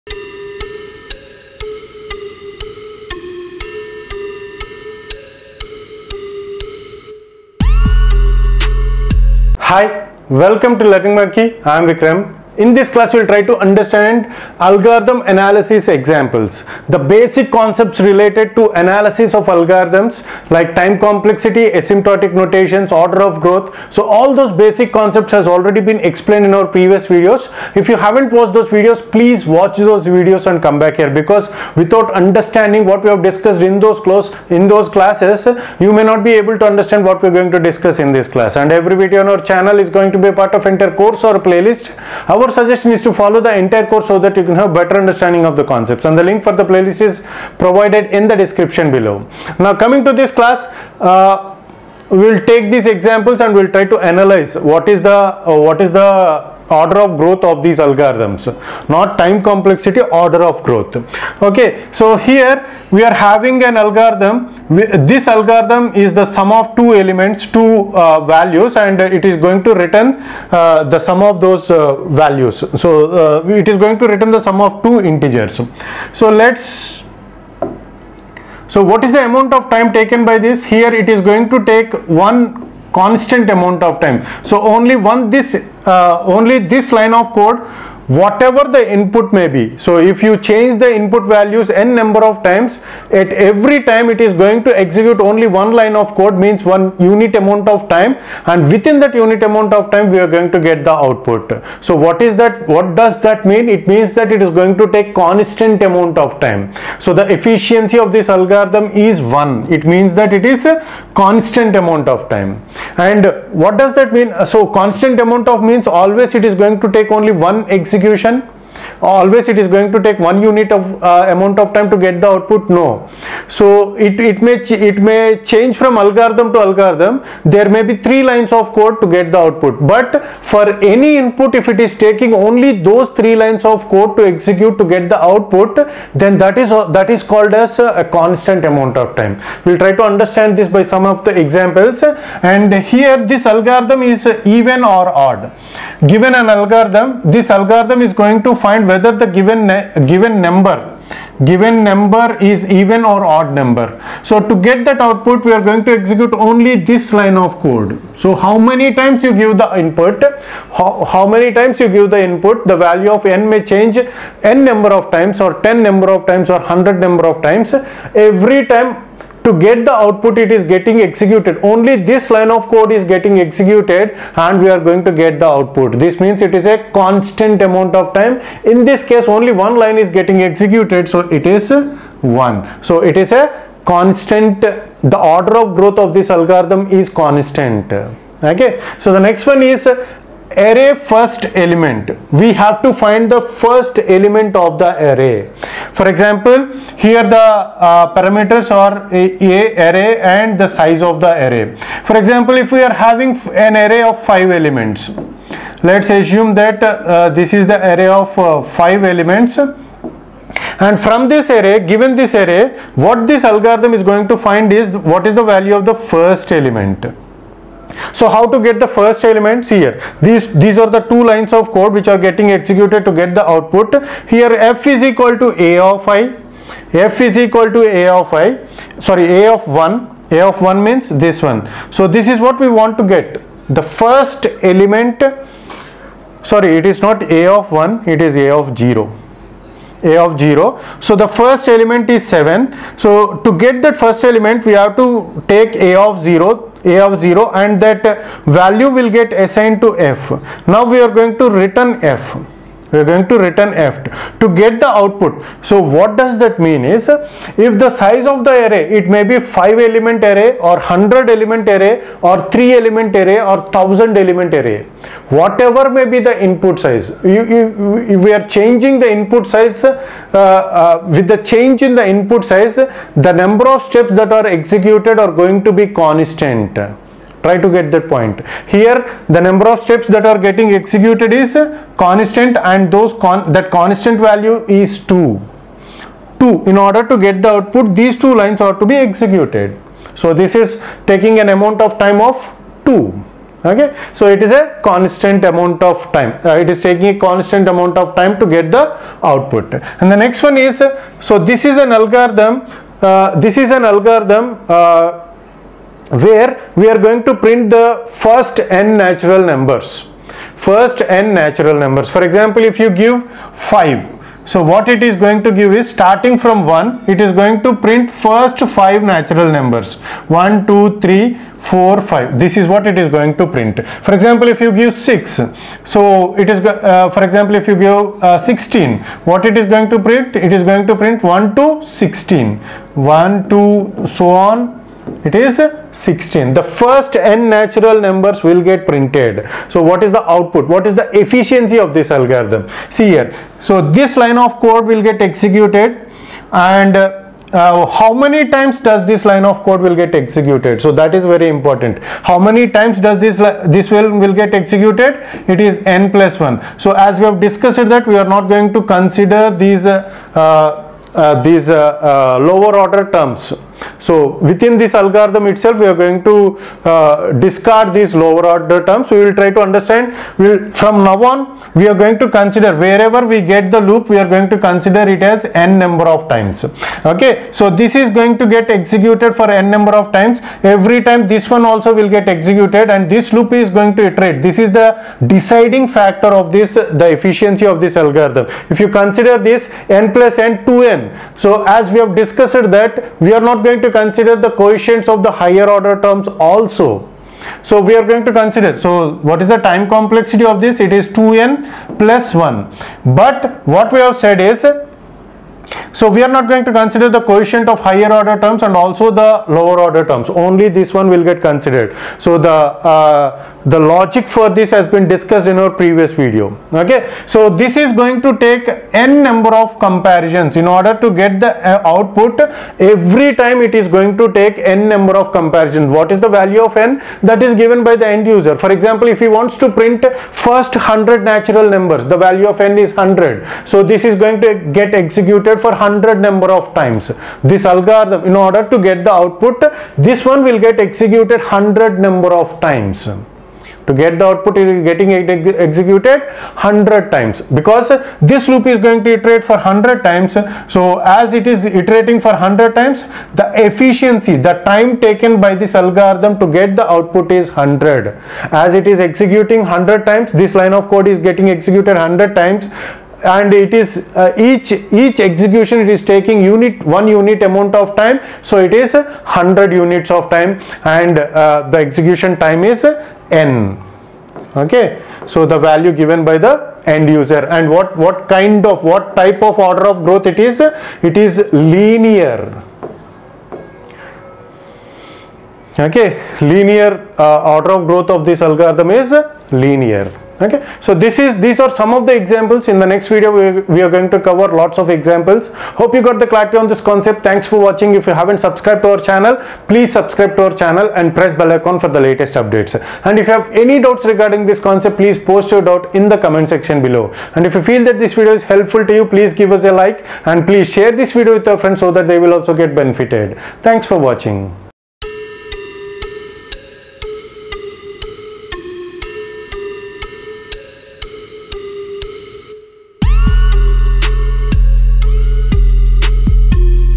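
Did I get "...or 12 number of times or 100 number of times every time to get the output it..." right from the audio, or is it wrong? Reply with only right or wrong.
wrong.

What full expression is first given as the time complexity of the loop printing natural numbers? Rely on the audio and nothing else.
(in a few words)
2n + 1.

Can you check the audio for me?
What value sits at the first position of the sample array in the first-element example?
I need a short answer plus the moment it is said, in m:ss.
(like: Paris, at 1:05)
7, at 4:02.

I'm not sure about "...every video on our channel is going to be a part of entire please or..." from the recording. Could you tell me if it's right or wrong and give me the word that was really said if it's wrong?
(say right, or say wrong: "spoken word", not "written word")
wrong: "course", not "please".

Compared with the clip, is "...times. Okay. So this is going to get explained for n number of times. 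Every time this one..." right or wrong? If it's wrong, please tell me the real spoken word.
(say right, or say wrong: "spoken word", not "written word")
wrong: "executed", not "explained".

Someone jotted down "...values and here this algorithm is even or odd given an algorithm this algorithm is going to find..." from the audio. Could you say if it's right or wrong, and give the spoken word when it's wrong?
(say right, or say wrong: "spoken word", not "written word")
wrong: "examples", not "values".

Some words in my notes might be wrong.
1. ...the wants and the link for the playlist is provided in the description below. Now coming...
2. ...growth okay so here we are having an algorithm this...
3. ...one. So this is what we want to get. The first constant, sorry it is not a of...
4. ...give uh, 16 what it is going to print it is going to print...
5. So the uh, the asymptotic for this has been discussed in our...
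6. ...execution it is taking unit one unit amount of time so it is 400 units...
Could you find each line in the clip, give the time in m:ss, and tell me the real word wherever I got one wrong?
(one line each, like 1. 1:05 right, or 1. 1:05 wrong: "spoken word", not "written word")
1. 0:45 wrong: "concepts", not "wants"
2. 1:00 right
3. 3:51 wrong: "element", not "constant"
4. 5:27 right
5. 6:52 wrong: "logic", not "asymptotic"
6. 7:45 wrong: "100", not "400".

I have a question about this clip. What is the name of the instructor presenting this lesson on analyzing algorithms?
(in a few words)
Vikram.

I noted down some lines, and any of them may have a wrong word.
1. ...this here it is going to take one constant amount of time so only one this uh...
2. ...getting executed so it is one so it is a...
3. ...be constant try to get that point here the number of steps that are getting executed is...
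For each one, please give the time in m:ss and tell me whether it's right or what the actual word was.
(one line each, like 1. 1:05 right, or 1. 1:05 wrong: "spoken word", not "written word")
1. 1:20 right
2. 3:00 right
3. 4:35 right.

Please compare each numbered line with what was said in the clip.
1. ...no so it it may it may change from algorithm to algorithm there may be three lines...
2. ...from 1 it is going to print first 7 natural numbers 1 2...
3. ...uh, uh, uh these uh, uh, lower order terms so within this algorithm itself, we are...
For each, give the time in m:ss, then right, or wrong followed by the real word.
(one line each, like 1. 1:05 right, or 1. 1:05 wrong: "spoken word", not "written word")
1. 2:02 right
2. 5:16 wrong: "5", not "7"
3. 5:59 right.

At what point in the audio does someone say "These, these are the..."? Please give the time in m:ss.
3:40.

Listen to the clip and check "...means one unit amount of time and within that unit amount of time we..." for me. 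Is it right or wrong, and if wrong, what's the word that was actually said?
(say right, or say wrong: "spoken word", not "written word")
right.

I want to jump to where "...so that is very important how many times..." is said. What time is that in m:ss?
5:50.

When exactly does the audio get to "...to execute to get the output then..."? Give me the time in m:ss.
2:14.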